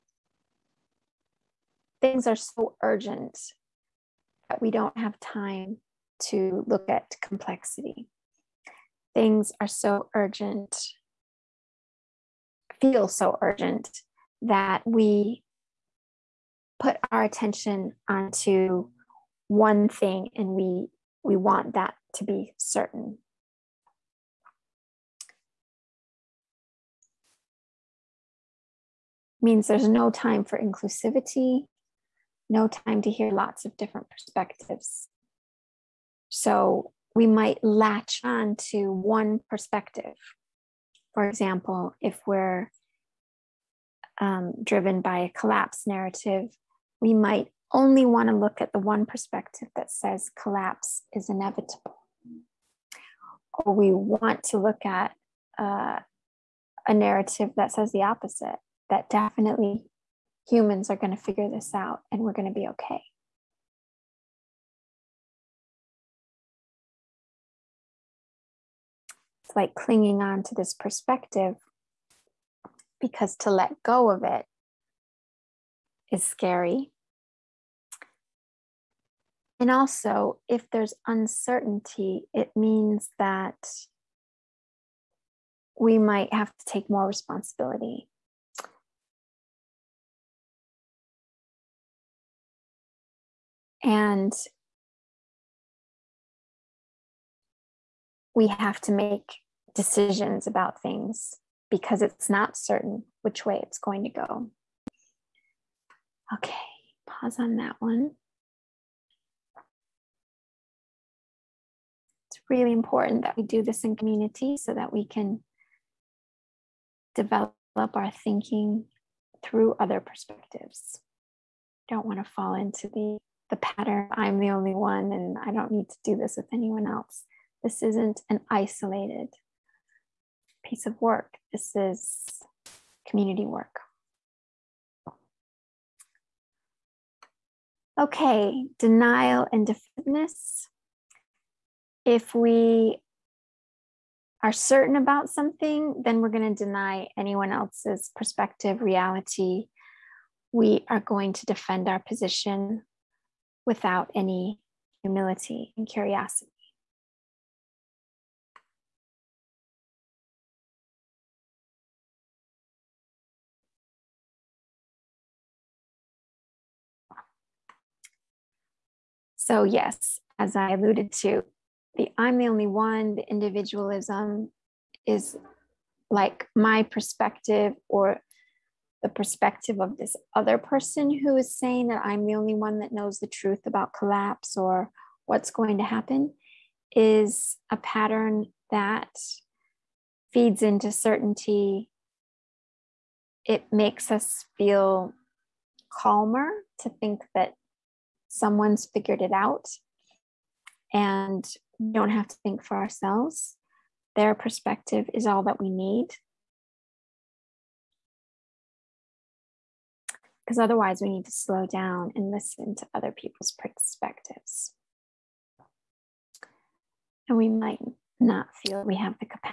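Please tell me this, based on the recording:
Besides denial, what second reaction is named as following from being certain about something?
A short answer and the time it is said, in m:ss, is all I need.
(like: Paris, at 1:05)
defensiveness, at 2:19.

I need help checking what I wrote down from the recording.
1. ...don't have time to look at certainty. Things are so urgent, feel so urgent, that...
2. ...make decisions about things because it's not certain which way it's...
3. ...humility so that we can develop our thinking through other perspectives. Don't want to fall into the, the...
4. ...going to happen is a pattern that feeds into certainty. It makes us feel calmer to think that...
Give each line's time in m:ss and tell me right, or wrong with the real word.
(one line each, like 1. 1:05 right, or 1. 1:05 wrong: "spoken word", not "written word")
1. 0:04 wrong: "complexity", not "certainty"
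2. 1:38 right
3. 1:53 wrong: "community", not "humility"
4. 3:05 right.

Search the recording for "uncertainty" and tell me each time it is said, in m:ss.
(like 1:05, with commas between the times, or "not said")
1:21.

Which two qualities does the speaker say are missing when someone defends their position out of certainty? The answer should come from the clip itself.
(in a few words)
humility and curiosity.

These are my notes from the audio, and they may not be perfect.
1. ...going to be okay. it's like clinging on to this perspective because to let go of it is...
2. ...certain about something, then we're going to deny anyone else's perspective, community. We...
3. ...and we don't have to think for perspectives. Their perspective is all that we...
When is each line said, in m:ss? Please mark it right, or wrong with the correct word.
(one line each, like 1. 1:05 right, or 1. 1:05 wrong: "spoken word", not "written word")
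1. 1:02 right
2. 2:24 wrong: "reality", not "community"
3. 3:20 wrong: "ourselves", not "perspectives".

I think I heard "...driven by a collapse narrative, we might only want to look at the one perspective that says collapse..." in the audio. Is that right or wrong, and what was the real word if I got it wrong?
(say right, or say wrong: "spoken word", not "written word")
right.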